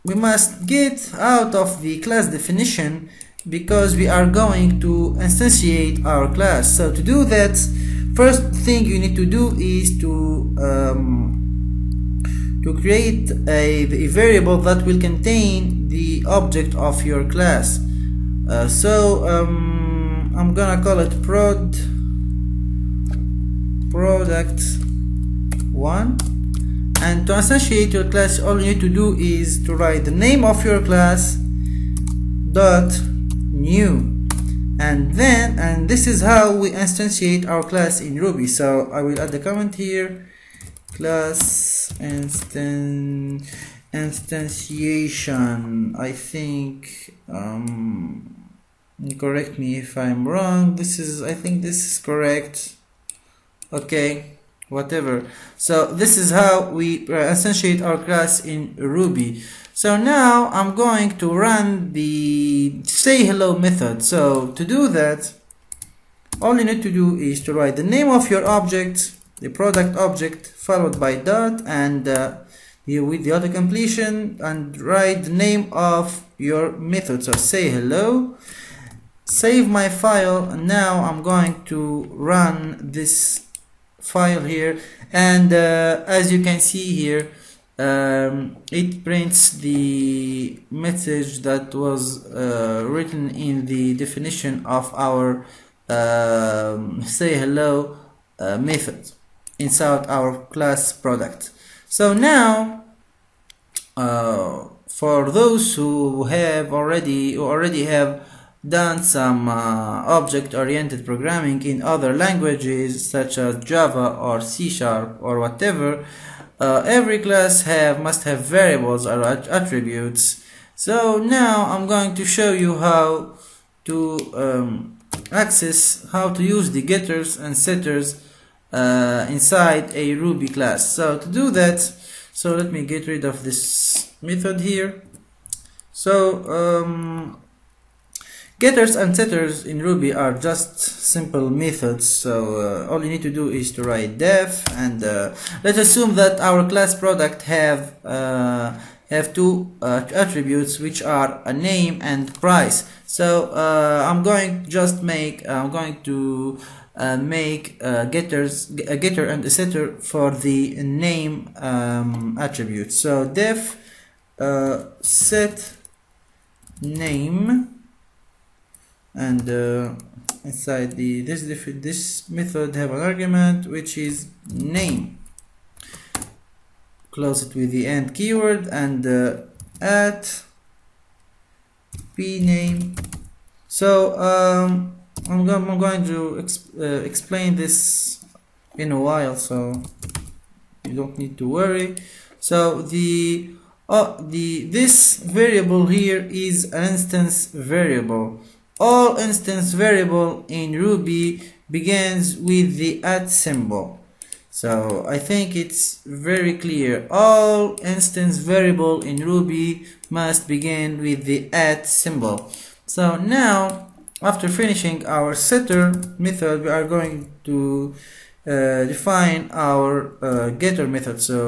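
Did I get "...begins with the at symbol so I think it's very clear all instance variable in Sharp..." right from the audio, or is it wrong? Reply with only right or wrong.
wrong.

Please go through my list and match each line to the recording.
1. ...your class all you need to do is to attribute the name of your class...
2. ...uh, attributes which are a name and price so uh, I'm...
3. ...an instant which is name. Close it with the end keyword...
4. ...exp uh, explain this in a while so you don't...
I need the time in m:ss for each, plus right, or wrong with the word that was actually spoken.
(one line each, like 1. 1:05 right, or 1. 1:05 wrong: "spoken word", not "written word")
1. 0:27 wrong: "write", not "attribute"
2. 2:29 right
3. 2:52 wrong: "argument", not "instant"
4. 3:06 right.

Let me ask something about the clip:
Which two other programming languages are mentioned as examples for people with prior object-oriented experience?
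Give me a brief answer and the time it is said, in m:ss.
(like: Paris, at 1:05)
Java or C Sharp, at 1:53.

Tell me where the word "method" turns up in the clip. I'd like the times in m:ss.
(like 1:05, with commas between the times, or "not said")
1:03, 1:16, 1:38, 2:14, 2:21, 2:52, 3:36, 3:40.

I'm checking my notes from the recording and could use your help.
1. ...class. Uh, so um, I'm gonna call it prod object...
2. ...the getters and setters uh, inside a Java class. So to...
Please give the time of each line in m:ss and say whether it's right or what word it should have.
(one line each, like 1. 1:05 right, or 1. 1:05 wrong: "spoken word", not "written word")
1. 0:17 wrong: "product", not "object"
2. 2:06 wrong: "Ruby", not "Java".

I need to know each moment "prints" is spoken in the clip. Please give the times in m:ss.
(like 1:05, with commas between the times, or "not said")
1:29.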